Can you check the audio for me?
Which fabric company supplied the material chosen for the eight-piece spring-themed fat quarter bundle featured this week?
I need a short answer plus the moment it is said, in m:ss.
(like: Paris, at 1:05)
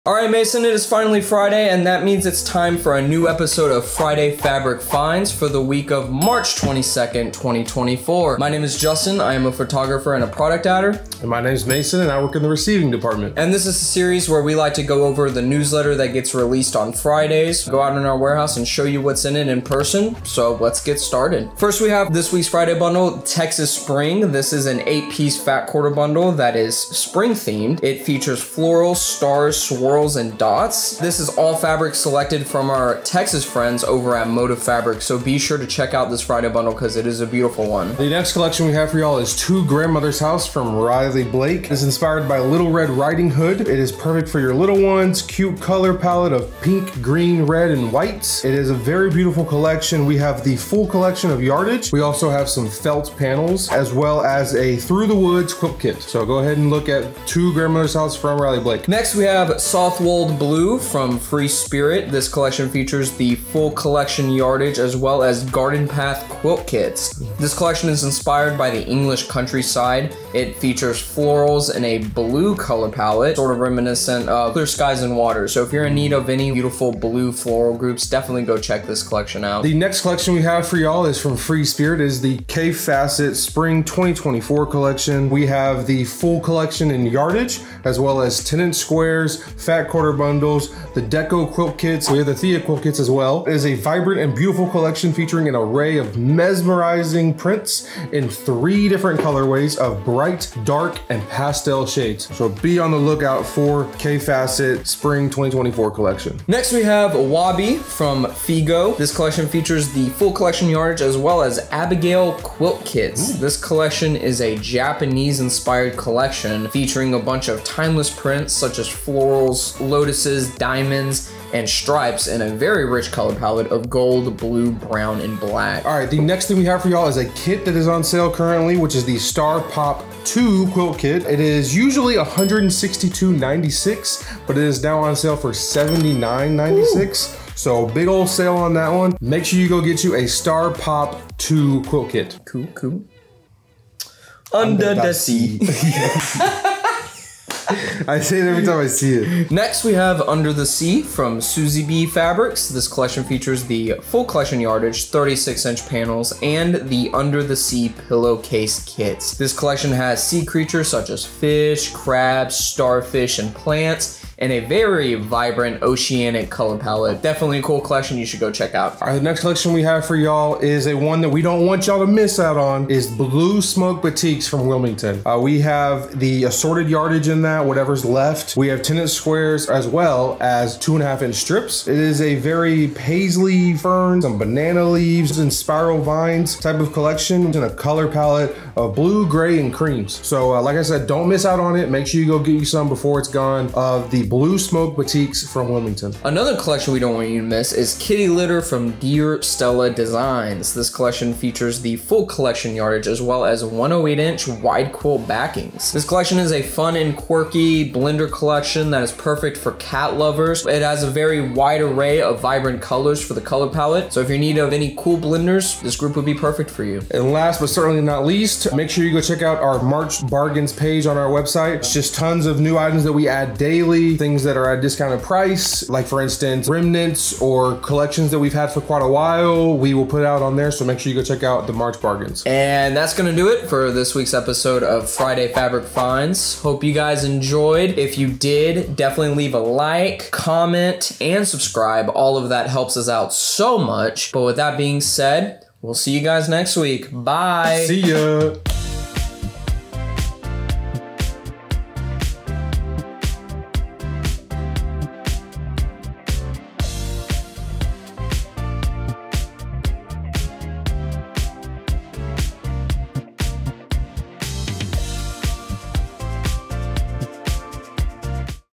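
Motive Fabric, at 0:34.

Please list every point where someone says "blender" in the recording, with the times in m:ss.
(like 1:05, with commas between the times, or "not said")
3:27, 3:35.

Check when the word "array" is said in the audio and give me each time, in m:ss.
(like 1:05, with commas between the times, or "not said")
1:35, 3:31.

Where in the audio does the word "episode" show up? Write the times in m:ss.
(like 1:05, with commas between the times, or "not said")
0:03, 3:54.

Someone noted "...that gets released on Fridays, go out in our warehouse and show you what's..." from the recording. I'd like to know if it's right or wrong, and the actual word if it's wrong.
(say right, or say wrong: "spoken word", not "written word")
right.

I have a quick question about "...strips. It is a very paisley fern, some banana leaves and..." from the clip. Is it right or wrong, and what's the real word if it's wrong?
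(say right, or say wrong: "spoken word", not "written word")
right.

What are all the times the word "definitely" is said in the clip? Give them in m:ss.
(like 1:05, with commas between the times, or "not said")
1:18, 2:47, 3:58.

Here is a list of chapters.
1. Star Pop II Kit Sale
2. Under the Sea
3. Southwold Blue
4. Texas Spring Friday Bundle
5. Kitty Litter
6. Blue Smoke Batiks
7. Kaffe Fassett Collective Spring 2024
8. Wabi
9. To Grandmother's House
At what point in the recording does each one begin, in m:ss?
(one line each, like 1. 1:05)
1. 2:06
2. 2:22
3. 0:58
4. 0:21
5. 3:16
6. 2:49
7. 1:19
8. 1:46
9. 0:38.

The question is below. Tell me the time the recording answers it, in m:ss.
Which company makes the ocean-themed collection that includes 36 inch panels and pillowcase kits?
2:31.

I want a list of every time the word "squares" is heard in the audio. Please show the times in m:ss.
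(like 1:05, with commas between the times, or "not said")
1:28, 2:59.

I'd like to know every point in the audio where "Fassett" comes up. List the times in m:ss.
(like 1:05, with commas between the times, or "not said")
1:22, 1:44.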